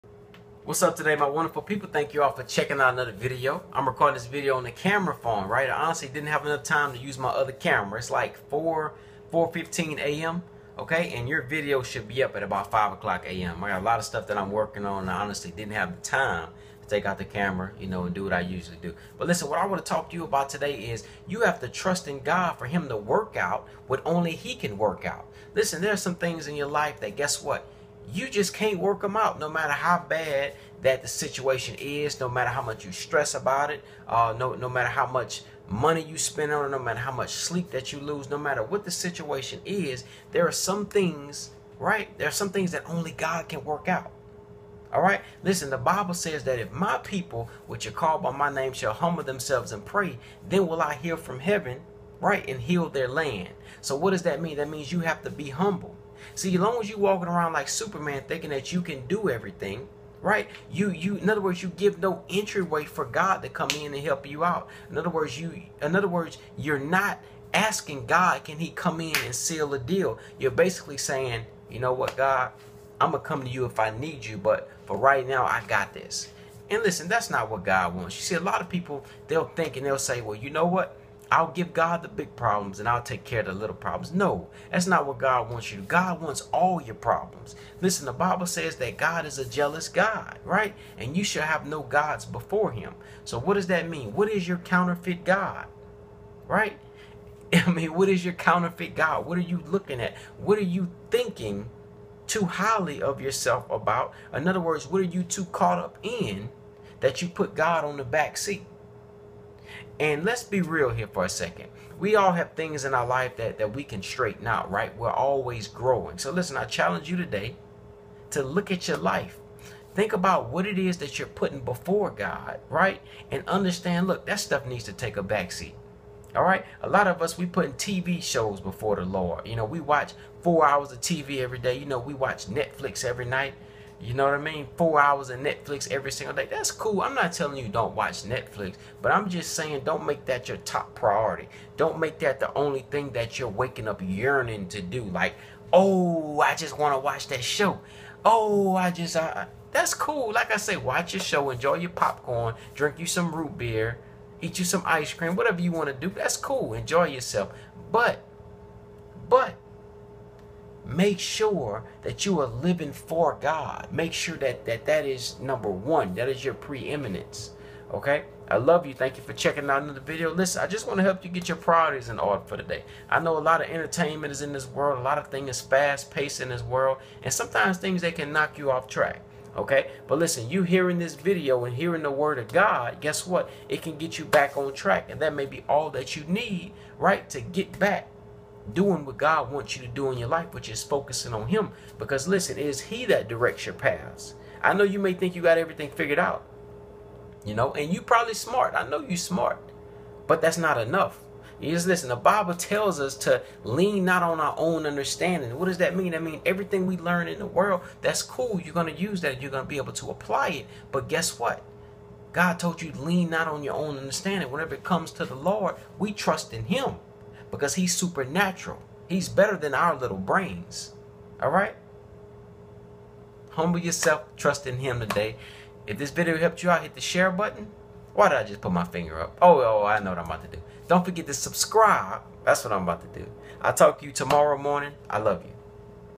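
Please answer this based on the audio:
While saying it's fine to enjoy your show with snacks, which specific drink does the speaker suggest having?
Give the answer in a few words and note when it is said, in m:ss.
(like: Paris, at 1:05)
root beer, at 2:33.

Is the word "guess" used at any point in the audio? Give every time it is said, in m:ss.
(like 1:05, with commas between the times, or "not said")
0:27, 3:03, 3:31.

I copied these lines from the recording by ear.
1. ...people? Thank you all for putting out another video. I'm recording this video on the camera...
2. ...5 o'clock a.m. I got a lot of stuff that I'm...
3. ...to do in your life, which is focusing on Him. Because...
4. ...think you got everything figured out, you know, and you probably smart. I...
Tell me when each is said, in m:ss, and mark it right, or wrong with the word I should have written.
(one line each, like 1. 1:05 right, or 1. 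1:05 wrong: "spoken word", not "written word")
1. 0:01 wrong: "checking", not "putting"
2. 0:12 right
3. 3:09 right
4. 3:15 right.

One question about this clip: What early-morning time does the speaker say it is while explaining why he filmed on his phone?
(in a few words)
4:15 a.m.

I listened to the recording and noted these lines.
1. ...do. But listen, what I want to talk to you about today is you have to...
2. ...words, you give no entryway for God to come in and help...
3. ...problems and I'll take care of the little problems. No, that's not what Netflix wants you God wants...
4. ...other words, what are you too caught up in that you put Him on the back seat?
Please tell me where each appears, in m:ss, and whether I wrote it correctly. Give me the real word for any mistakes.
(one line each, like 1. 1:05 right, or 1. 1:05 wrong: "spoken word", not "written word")
1. 0:18 right
2. 1:01 right
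3. 1:22 wrong: "God", not "Netflix"
4. 1:44 wrong: "God", not "Him".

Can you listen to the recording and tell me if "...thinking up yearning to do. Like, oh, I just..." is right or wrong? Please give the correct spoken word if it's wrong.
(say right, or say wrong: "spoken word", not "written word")
wrong: "waking", not "thinking".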